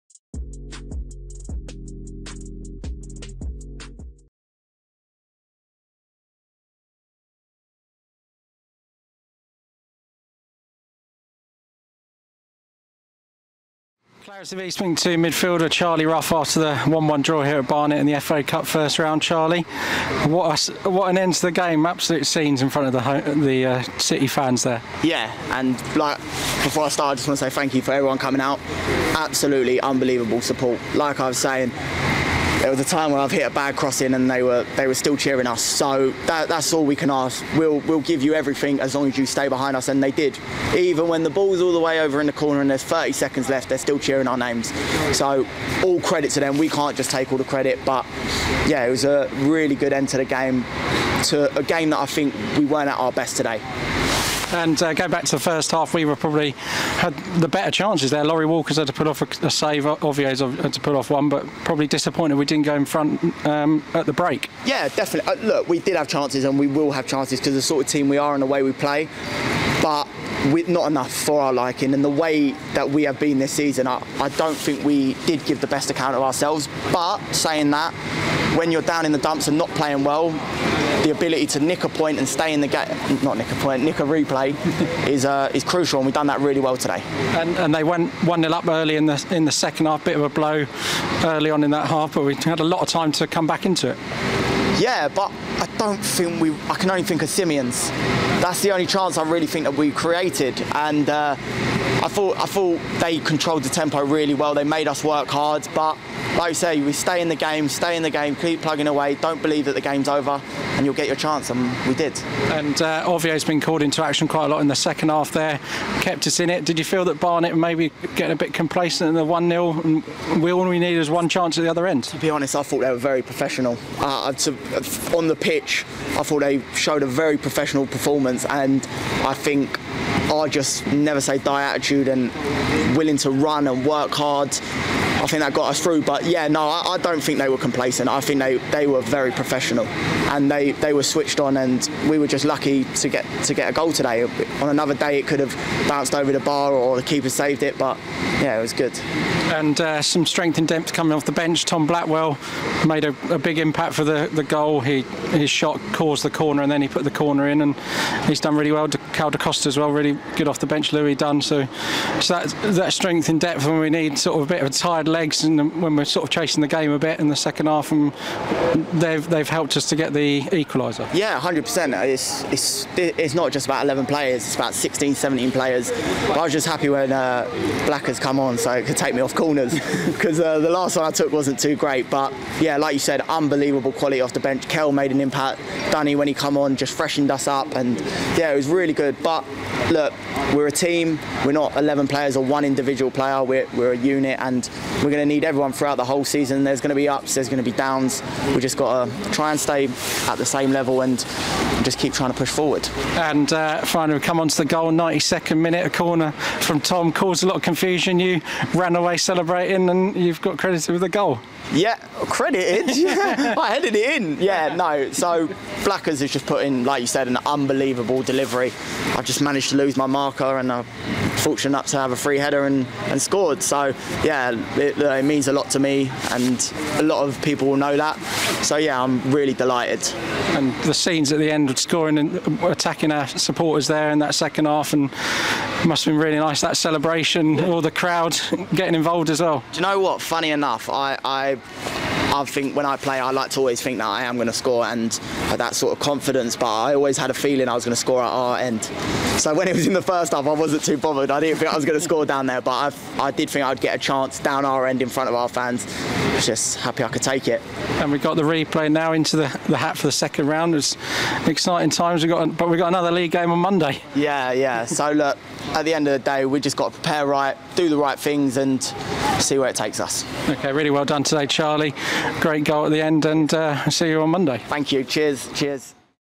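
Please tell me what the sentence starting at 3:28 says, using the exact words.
You ran away celebrating and you've got credited with a goal.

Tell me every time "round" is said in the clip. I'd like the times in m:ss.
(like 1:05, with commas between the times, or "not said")
0:18, 4:20.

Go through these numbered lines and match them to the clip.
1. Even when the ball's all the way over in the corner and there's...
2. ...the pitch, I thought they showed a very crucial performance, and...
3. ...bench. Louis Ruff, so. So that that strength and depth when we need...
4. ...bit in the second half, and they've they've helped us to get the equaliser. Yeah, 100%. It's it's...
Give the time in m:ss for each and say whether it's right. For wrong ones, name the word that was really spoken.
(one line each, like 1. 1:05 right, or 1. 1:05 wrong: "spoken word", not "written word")
1. 0:40 right
2. 2:05 wrong: "professional", not "crucial"
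3. 2:40 wrong: "Dunn", not "Ruff"
4. 2:46 right.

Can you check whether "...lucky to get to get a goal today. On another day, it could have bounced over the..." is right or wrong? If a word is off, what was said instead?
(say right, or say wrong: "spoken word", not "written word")
right.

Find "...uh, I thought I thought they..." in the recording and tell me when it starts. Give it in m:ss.
1:41.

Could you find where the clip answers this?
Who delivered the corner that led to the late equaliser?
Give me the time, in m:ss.
2:31.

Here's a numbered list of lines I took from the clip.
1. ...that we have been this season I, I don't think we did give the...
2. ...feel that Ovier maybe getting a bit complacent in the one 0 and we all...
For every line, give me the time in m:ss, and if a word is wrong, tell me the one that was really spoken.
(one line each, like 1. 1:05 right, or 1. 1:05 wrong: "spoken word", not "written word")
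1. 1:12 right
2. 1:56 wrong: "Barnet", not "Ovier".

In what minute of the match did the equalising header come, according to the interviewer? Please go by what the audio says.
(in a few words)
92nd minute.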